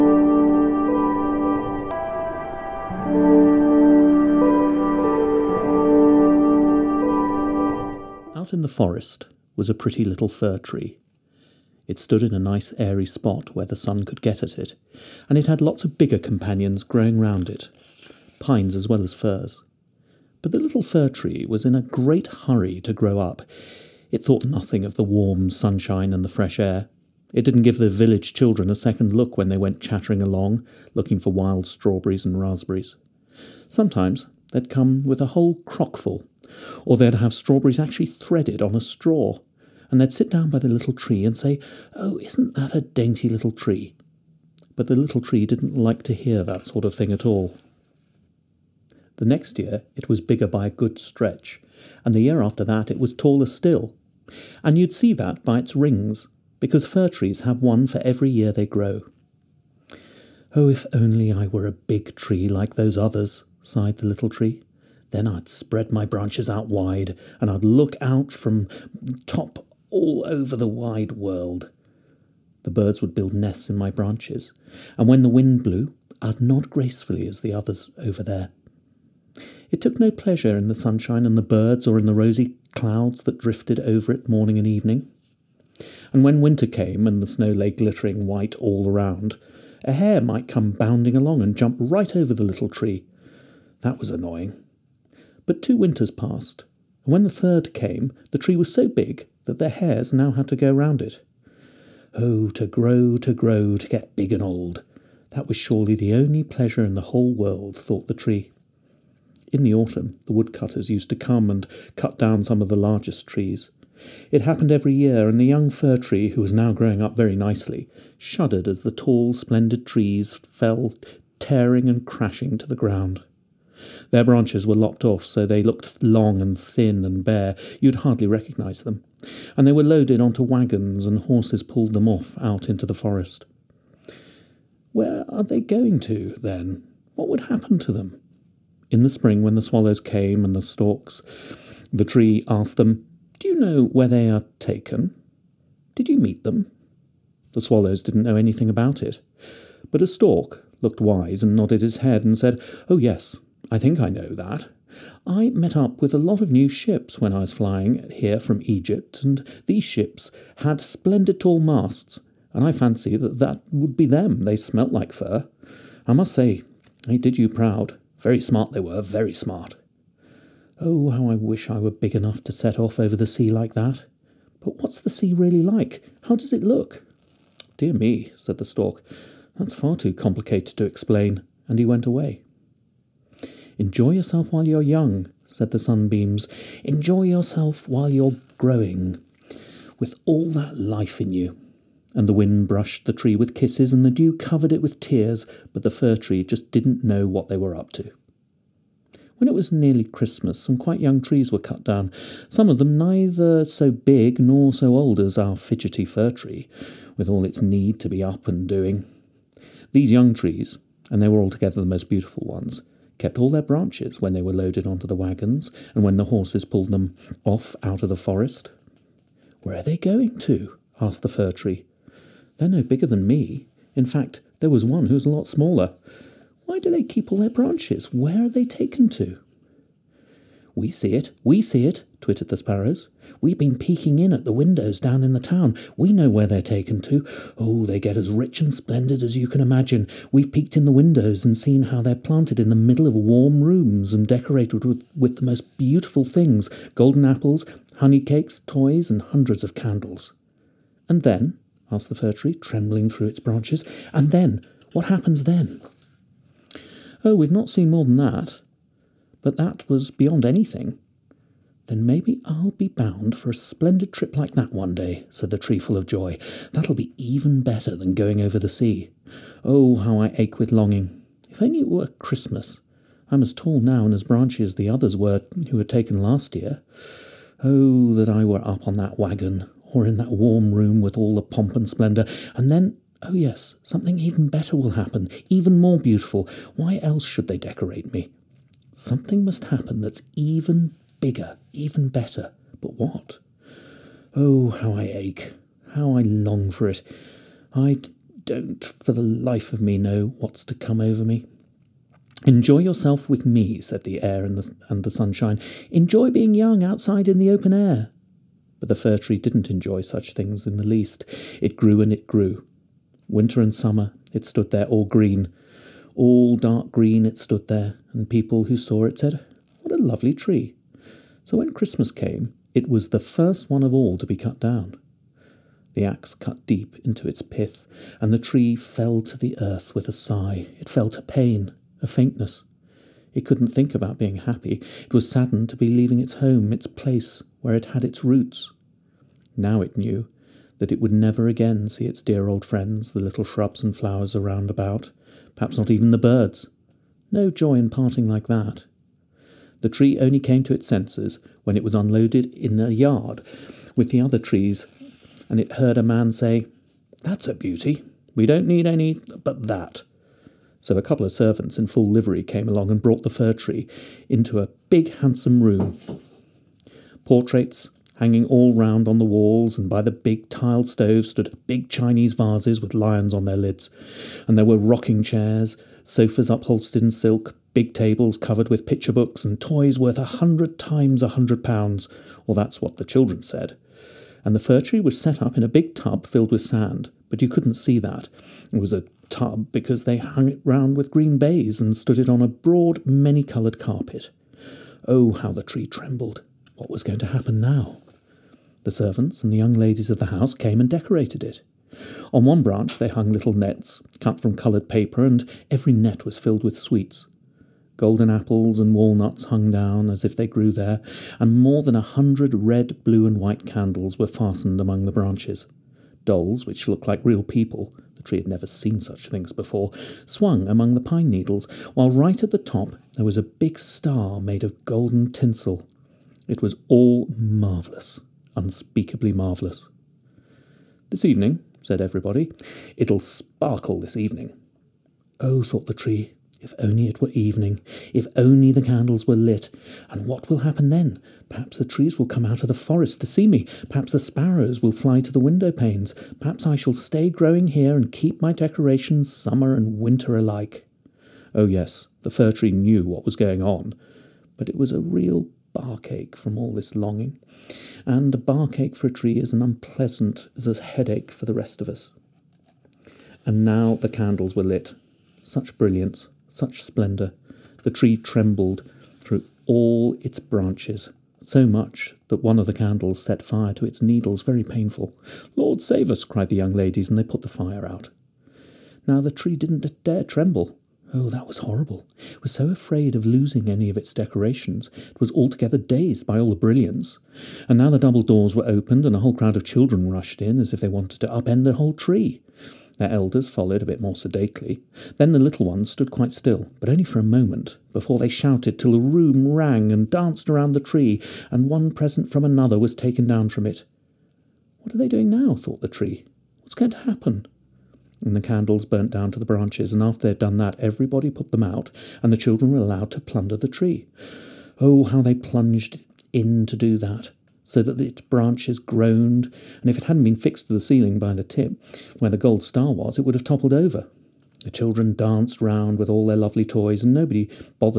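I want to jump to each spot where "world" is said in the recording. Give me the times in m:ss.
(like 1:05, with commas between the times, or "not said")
1:11, 1:47.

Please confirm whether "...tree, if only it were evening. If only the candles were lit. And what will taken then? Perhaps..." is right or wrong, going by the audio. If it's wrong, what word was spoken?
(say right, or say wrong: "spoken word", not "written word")
wrong: "happen", not "taken".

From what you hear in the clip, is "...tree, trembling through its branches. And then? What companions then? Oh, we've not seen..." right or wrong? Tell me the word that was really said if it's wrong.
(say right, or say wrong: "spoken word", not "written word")
wrong: "happens", not "companions".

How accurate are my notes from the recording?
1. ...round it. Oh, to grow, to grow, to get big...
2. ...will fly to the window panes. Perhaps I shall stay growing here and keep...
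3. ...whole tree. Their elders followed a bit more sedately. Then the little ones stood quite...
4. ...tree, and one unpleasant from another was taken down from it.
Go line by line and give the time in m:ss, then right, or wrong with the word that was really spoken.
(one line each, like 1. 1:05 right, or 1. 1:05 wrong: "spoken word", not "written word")
1. 1:40 right
2. 7:24 right
3. 8:11 right
4. 8:20 wrong: "present", not "unpleasant".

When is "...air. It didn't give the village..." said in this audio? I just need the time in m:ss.
0:26.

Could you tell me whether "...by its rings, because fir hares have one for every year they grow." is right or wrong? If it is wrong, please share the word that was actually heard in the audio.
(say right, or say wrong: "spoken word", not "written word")
wrong: "trees", not "hares".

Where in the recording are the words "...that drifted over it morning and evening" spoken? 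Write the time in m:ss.
1:23.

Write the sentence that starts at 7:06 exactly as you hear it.
It was all marvellous, unspeakably marvellous.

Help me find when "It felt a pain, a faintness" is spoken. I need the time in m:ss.
5:30.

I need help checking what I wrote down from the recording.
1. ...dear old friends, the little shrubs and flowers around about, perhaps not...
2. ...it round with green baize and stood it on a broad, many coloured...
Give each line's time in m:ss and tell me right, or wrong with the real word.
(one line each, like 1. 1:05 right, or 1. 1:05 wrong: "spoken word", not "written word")
1. 5:42 right
2. 6:30 right.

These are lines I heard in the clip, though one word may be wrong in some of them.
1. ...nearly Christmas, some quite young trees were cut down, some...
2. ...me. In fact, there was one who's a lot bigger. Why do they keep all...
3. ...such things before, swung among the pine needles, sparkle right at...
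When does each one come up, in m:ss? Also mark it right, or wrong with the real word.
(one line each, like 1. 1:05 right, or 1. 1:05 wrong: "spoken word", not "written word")
1. 3:19 right
2. 3:43 wrong: "smaller", not "bigger"
3. 6:59 wrong: "while", not "sparkle".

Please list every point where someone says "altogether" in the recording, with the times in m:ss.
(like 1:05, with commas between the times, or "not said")
3:31, 8:05.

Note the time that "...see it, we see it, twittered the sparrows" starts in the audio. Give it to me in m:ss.
3:50.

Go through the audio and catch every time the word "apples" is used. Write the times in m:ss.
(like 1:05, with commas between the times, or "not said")
4:07, 6:48.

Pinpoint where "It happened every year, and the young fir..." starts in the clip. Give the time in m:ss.
1:54.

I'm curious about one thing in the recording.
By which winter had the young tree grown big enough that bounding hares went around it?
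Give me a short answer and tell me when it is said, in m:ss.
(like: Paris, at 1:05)
3, at 1:37.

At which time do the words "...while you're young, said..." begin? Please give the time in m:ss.
3:04.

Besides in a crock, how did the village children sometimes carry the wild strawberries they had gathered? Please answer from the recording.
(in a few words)
threaded on a straw.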